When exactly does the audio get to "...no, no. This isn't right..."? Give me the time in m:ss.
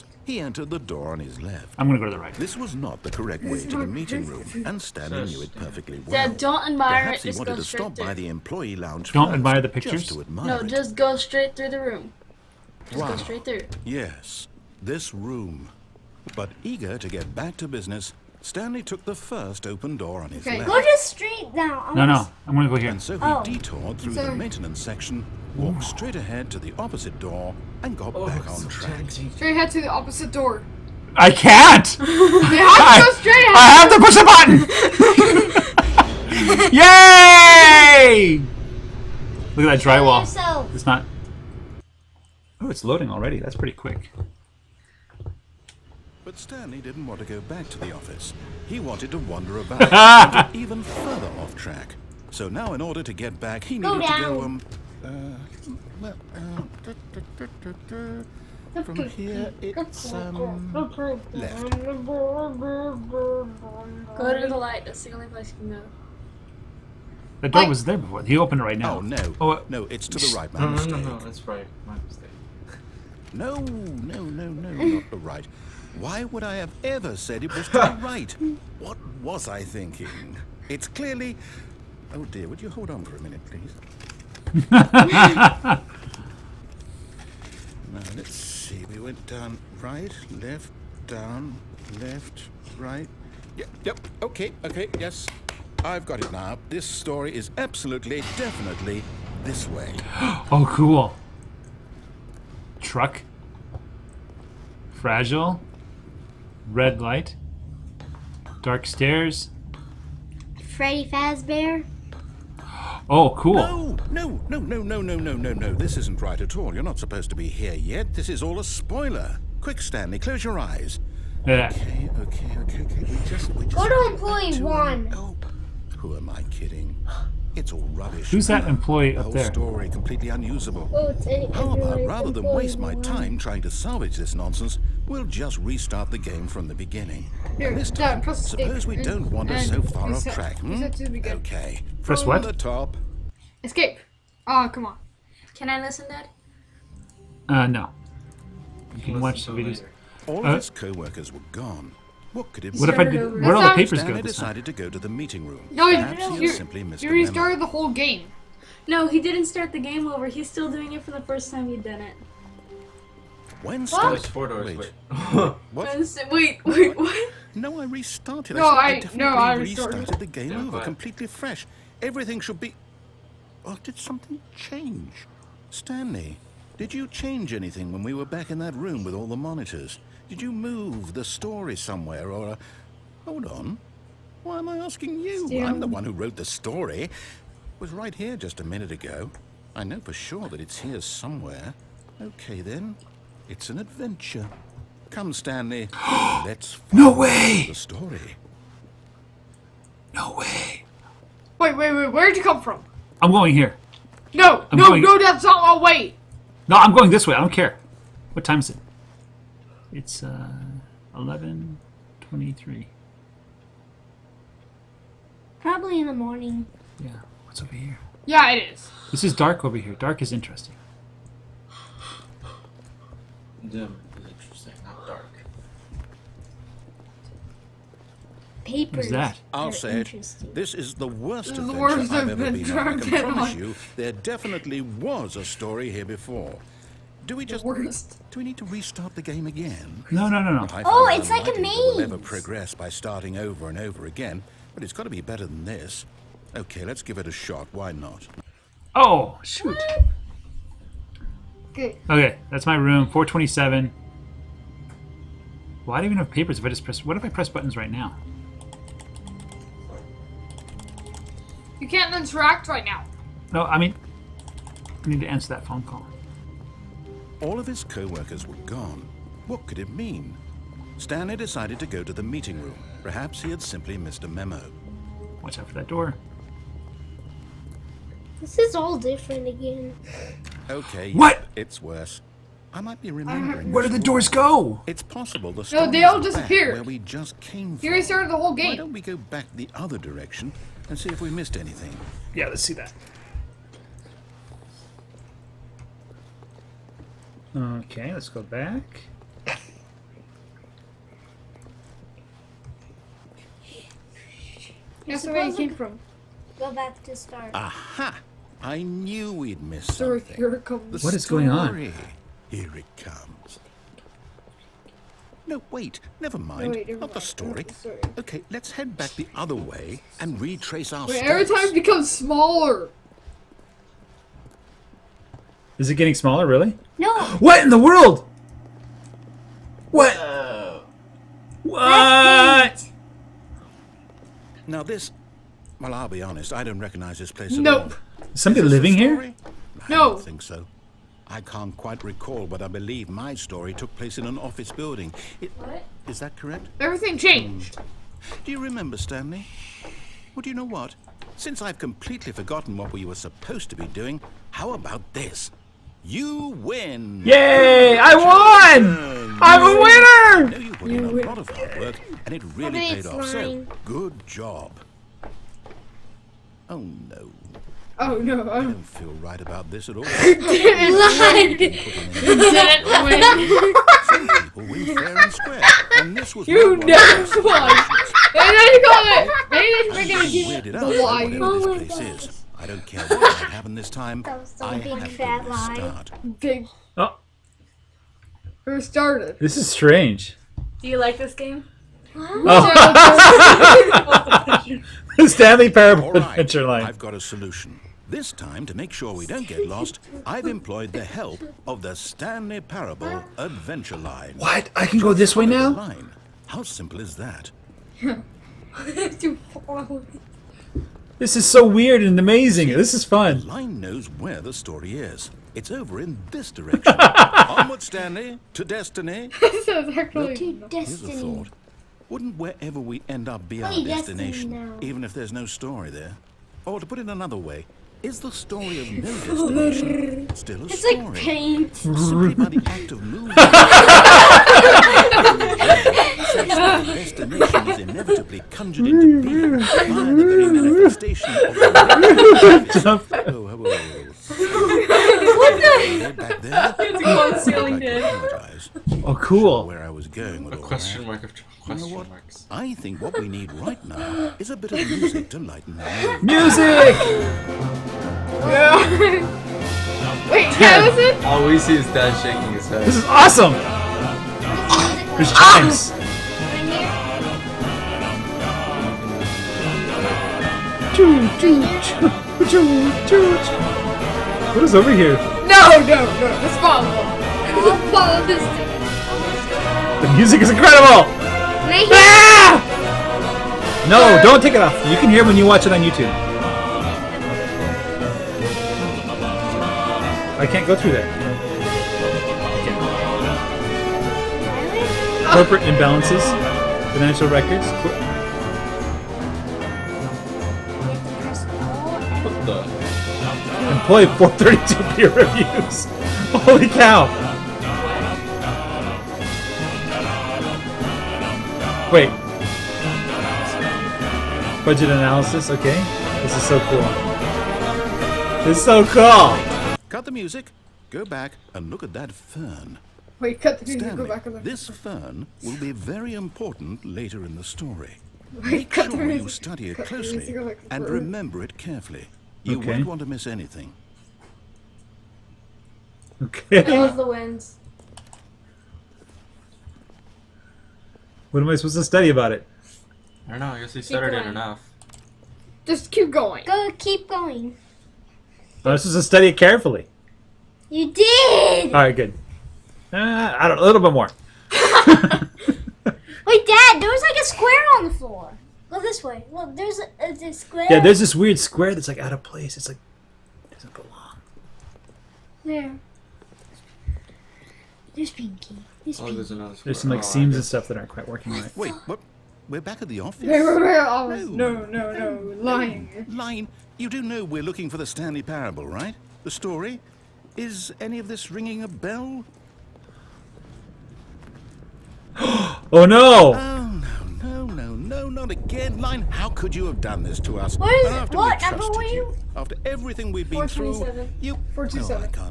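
1:55.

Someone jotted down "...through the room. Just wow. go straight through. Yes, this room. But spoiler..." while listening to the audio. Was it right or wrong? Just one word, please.
wrong.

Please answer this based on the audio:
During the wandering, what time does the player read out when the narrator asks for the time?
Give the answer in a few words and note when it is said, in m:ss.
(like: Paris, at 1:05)
11.23, at 3:31.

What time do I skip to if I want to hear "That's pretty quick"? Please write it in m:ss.
0:43.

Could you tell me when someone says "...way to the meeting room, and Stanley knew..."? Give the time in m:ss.
0:03.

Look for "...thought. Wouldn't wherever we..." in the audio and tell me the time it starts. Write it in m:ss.
7:01.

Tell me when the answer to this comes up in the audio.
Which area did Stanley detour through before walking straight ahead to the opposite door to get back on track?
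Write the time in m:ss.
0:24.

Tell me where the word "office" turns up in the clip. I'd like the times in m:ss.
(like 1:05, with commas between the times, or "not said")
0:47, 5:44, 9:32.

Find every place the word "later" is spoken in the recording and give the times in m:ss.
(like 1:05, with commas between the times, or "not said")
2:29, 8:46.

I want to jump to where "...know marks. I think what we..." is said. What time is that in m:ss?
7:31.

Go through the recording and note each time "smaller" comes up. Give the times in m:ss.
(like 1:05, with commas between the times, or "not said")
5:22, 5:26.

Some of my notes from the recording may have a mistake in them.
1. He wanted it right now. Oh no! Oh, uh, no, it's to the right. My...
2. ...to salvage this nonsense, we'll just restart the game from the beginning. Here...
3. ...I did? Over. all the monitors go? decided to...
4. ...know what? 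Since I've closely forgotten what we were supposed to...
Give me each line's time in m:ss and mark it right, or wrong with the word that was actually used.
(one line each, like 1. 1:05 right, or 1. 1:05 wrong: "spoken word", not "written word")
1. 1:08 wrong: "opened", not "wanted"
2. 2:13 right
3. 2:32 wrong: "papers", not "monitors"
4. 5:50 wrong: "completely", not "closely".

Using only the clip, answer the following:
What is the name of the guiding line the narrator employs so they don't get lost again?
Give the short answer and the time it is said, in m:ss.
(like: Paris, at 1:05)
Stanley Parable Adventure Line, at 6:41.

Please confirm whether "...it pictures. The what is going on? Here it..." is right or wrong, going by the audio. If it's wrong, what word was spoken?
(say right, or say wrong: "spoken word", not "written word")
wrong: "comes", not "pictures".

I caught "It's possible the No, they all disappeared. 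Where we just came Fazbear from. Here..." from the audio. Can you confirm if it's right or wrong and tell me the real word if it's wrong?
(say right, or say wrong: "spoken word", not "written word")
wrong: "Here", not "Fazbear".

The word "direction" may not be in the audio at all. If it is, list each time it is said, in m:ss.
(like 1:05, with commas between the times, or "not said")
4:49, 6:56.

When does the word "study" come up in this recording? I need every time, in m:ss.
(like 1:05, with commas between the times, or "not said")
8:49, 9:01, 9:09.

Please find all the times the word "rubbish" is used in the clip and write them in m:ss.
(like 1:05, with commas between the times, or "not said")
2:07.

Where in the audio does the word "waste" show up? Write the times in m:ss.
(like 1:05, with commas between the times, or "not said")
2:12.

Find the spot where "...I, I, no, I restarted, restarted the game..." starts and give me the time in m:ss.
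2:48.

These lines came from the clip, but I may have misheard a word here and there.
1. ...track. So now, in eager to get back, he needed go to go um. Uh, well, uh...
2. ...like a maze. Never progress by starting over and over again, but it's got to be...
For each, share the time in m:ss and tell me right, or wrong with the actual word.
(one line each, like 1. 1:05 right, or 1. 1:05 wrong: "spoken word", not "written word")
1. 0:51 wrong: "order", not "eager"
2. 4:01 right.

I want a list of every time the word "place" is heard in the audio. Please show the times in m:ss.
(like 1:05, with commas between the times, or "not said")
1:05, 5:37, 5:43, 9:22.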